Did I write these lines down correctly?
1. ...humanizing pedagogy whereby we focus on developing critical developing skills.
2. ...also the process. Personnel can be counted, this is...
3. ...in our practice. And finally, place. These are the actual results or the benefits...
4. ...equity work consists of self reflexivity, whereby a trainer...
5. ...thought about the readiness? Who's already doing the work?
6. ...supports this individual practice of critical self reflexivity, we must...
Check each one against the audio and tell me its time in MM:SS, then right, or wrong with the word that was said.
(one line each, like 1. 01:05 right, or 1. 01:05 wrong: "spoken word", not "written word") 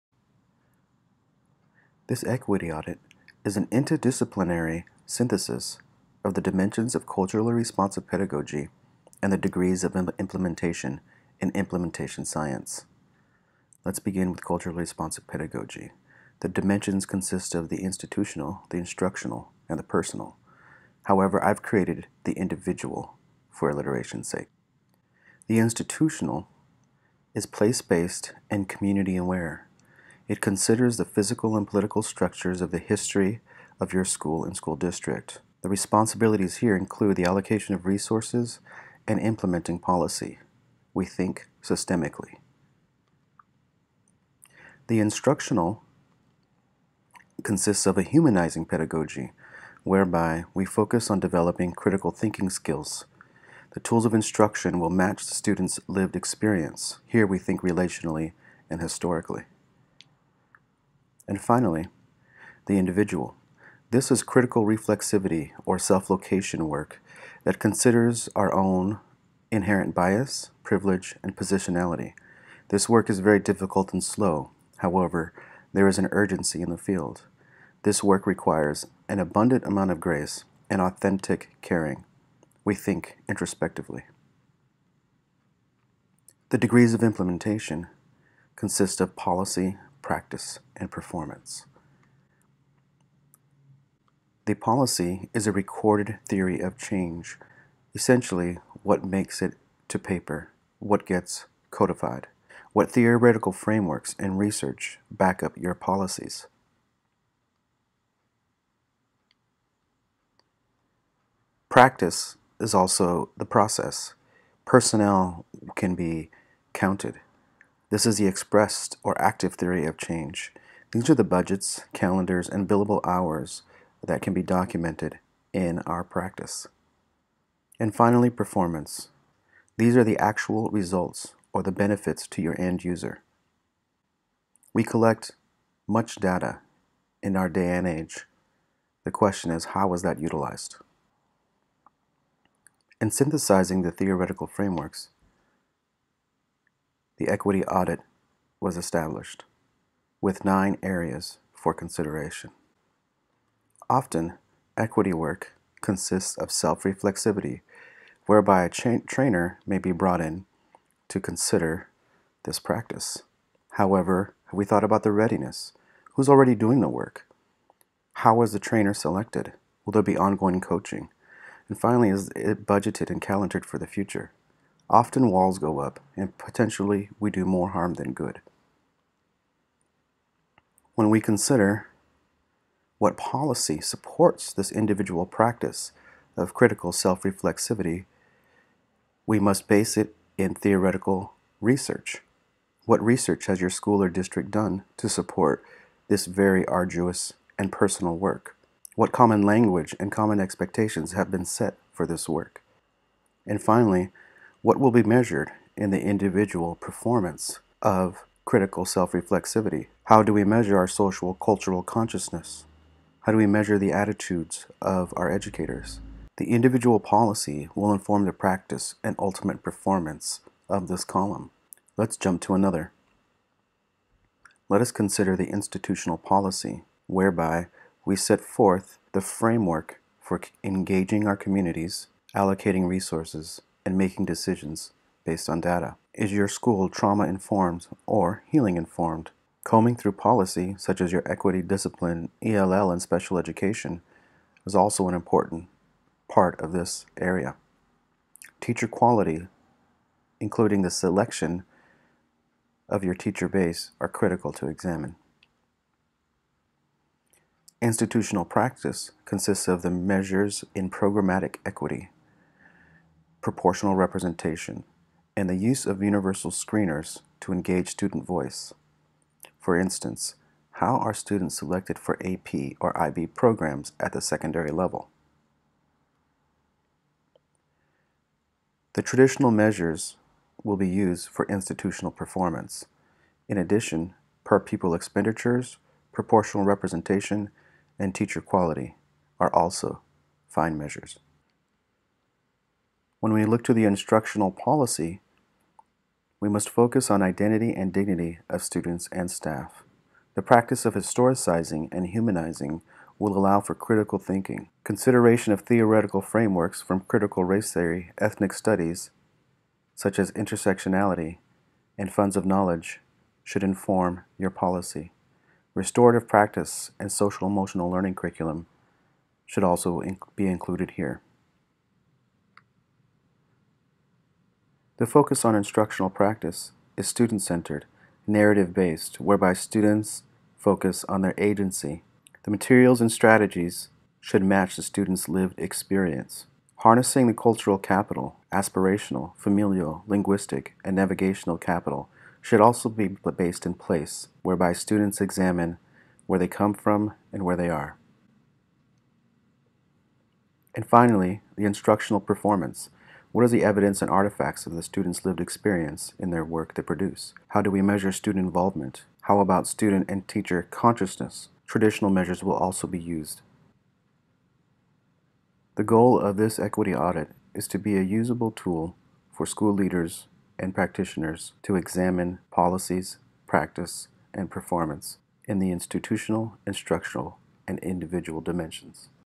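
1. 00:48 wrong: "thinking", not "developing"
2. 01:52 right
3. 02:05 wrong: "performance", not "place"
4. 02:34 right
5. 02:44 right
6. 03:03 right.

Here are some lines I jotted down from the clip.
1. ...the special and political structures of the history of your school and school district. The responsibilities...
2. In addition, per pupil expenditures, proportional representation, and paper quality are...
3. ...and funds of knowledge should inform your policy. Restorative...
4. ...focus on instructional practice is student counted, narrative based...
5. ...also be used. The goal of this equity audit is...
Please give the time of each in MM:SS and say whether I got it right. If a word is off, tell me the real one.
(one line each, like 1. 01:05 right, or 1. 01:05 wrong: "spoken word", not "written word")
1. 00:30 wrong: "physical", not "special"
2. 04:43 wrong: "teacher", not "paper"
3. 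05:11 right
4. 05:25 wrong: "centered", not "counted"
5. 06:02 right.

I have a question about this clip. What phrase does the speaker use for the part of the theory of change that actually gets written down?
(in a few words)
what makes it to paper.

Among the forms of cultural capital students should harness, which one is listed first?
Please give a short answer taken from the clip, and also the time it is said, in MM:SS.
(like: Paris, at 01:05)
aspirational, at 05:38.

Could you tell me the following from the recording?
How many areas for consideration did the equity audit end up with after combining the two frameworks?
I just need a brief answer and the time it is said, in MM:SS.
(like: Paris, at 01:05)
9, at 02:30.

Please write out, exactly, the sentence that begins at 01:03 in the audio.
This is critical reflexivity or self location work that considers our own inherent bias, privilege, and positionality.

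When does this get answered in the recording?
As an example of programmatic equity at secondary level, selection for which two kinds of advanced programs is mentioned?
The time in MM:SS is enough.
04:32.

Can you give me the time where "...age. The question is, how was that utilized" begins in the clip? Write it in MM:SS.
02:17.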